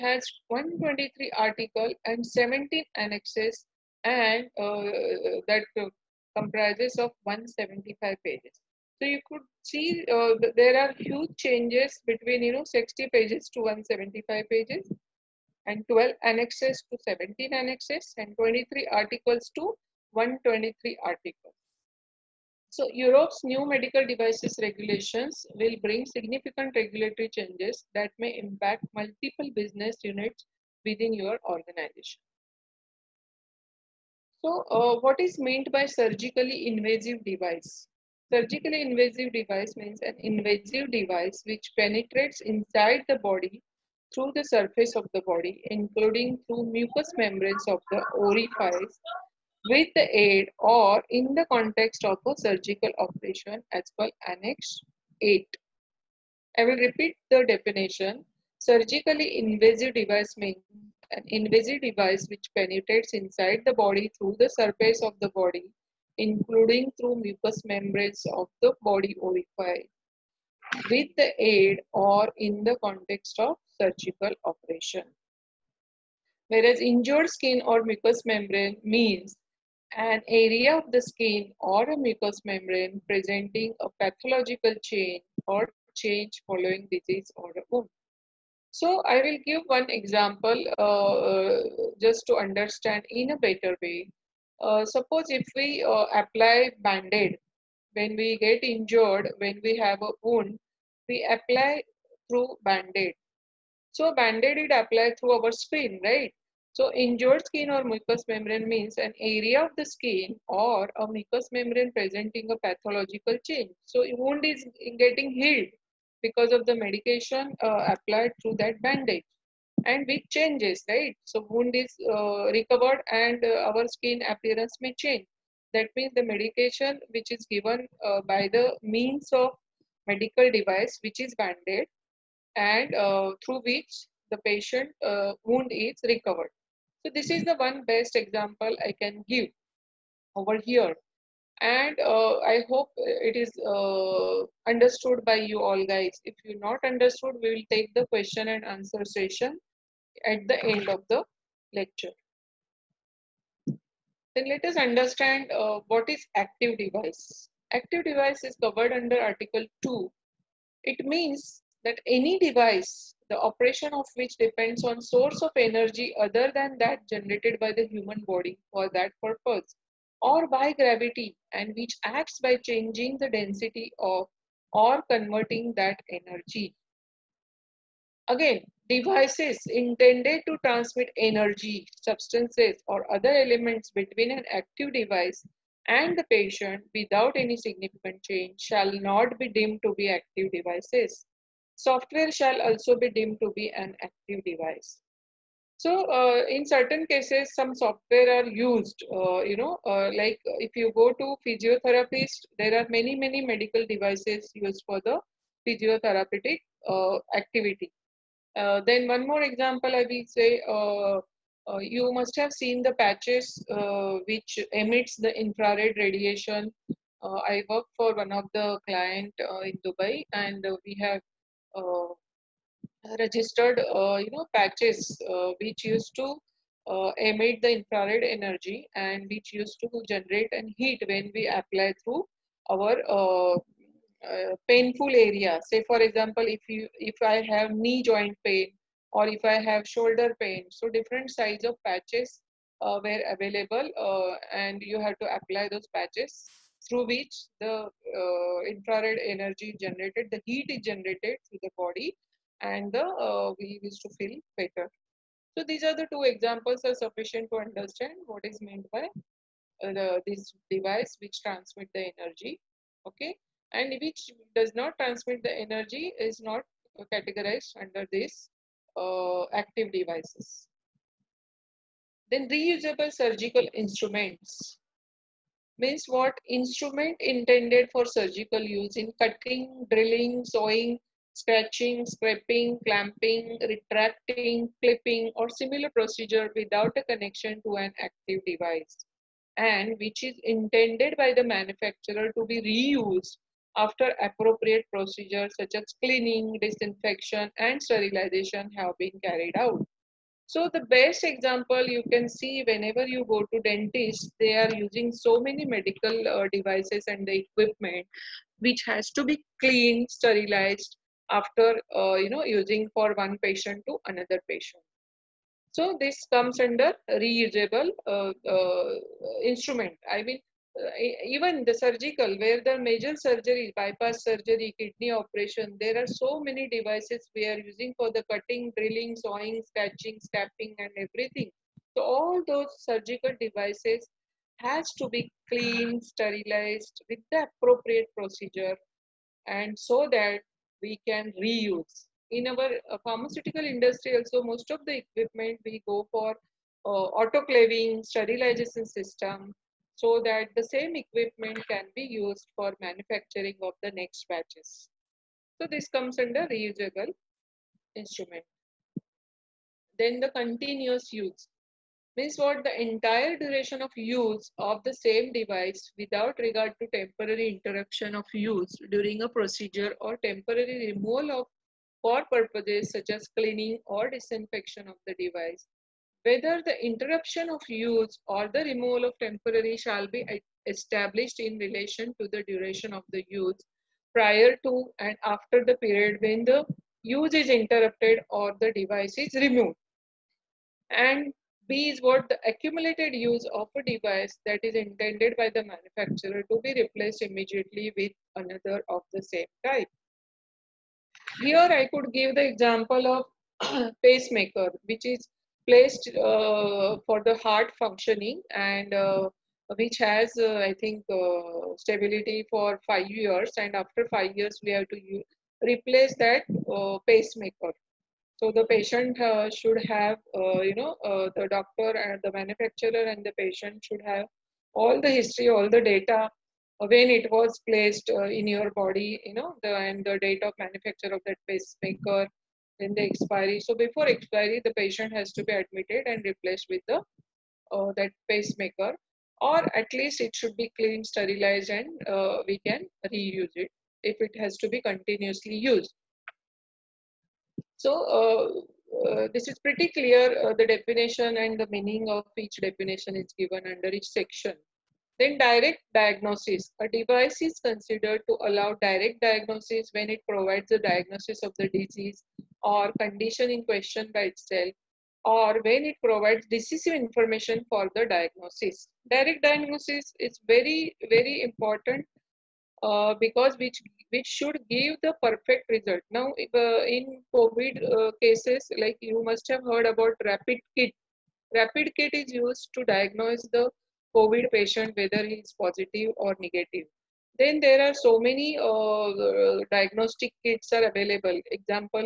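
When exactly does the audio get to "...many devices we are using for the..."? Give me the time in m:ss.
5:26.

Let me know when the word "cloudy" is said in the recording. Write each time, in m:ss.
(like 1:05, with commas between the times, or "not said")
not said.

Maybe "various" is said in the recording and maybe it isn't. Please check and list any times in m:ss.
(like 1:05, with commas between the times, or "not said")
not said.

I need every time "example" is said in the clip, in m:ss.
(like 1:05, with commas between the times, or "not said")
1:29, 2:18, 3:29, 3:56, 4:16, 5:01, 6:42, 8:11.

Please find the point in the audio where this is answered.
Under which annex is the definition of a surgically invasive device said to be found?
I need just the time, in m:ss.
0:54.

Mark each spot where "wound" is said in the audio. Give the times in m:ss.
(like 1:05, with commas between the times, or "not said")
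1:27, 1:40, 1:54, 2:01, 2:15.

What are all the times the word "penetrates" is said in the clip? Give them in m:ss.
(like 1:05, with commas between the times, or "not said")
0:41, 1:02.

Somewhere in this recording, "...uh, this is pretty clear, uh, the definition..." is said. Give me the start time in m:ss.
7:29.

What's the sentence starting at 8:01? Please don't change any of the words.
Rapid kit is used to diagnose the COVID patient whether he is positive or negative.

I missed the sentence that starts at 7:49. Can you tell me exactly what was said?
Direct diagnosis is very, very important uh, because which which should give the perfect result.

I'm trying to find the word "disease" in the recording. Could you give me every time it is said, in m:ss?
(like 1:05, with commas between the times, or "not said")
1:26, 7:41.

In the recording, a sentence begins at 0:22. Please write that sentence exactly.
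So Europe's new medical devices regulations will bring significant regulatory changes that may impact multiple business units within your organization.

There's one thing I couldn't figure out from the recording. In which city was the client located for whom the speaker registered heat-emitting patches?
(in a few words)
Dubai.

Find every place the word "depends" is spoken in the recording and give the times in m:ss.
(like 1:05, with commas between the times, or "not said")
2:44.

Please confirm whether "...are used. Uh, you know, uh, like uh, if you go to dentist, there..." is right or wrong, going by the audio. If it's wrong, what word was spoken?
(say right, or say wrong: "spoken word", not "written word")
wrong: "physiotherapist", not "dentist".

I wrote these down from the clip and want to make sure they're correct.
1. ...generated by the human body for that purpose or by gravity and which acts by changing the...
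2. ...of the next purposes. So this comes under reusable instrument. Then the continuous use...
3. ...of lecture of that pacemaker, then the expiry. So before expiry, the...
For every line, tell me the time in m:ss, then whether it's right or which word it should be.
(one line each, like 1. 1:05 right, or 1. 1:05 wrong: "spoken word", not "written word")
1. 2:47 right
2. 5:53 wrong: "batches", not "purposes"
3. 7:10 wrong: "manufacture", not "lecture".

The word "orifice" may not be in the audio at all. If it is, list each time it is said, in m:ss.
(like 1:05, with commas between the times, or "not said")
0:48, 1:09.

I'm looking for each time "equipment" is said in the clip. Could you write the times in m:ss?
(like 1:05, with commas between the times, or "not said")
5:07, 5:44, 5:50.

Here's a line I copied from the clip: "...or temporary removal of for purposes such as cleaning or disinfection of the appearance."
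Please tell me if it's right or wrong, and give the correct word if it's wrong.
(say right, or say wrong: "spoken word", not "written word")
wrong: "device", not "appearance".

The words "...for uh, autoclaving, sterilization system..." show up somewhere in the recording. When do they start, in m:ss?
5:46.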